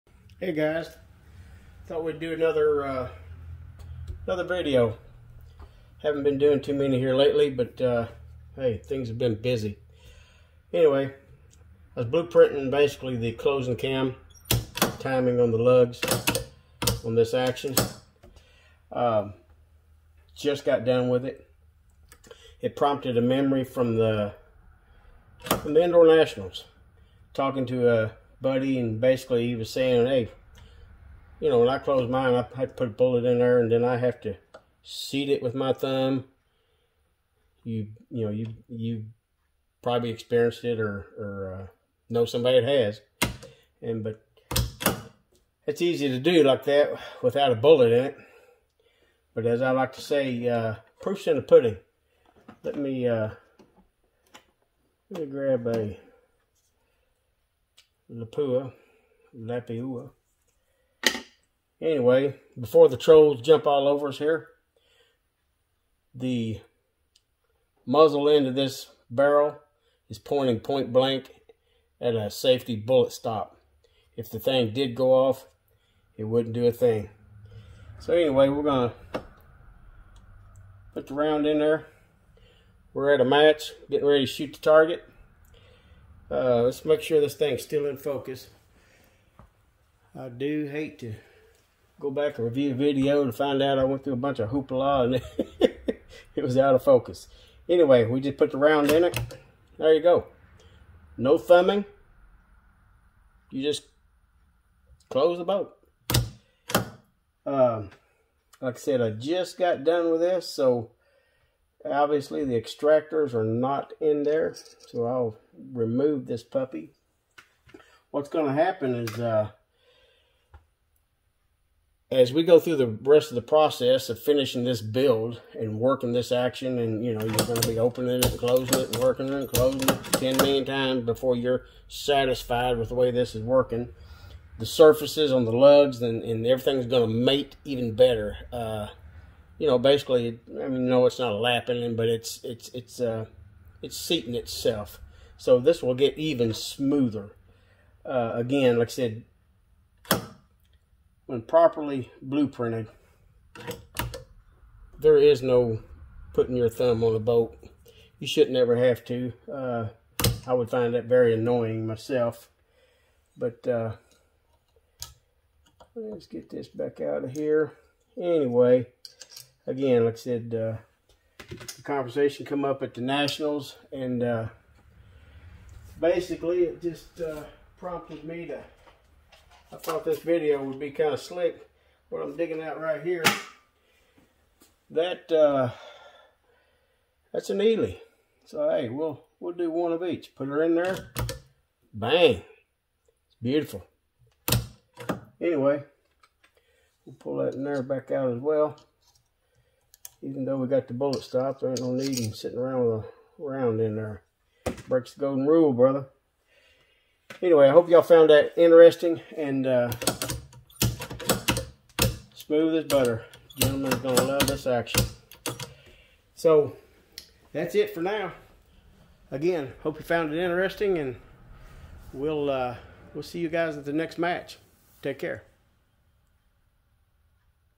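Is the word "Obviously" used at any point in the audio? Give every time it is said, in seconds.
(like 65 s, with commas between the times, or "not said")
111 s.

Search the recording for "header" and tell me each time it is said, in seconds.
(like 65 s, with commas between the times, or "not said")
not said.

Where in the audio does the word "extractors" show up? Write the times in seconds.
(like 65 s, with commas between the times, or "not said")
112 s.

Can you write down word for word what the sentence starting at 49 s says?
But as I like to say, uh, proof's in the pudding.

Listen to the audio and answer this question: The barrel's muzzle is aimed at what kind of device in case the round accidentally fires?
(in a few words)
Safety bullet stop.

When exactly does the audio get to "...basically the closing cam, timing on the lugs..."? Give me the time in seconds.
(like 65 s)
12 s.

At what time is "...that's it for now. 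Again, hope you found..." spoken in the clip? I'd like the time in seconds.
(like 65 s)
217 s.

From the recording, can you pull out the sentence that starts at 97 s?
Anyway, we just put the round in it.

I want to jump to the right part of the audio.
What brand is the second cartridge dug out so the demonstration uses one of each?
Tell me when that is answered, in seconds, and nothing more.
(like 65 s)
187 s.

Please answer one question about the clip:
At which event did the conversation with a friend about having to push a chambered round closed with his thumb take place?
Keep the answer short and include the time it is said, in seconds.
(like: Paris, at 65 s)
Indoor Nationals, at 25 s.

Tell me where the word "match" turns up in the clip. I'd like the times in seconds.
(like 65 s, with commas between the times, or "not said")
83 s, 224 s.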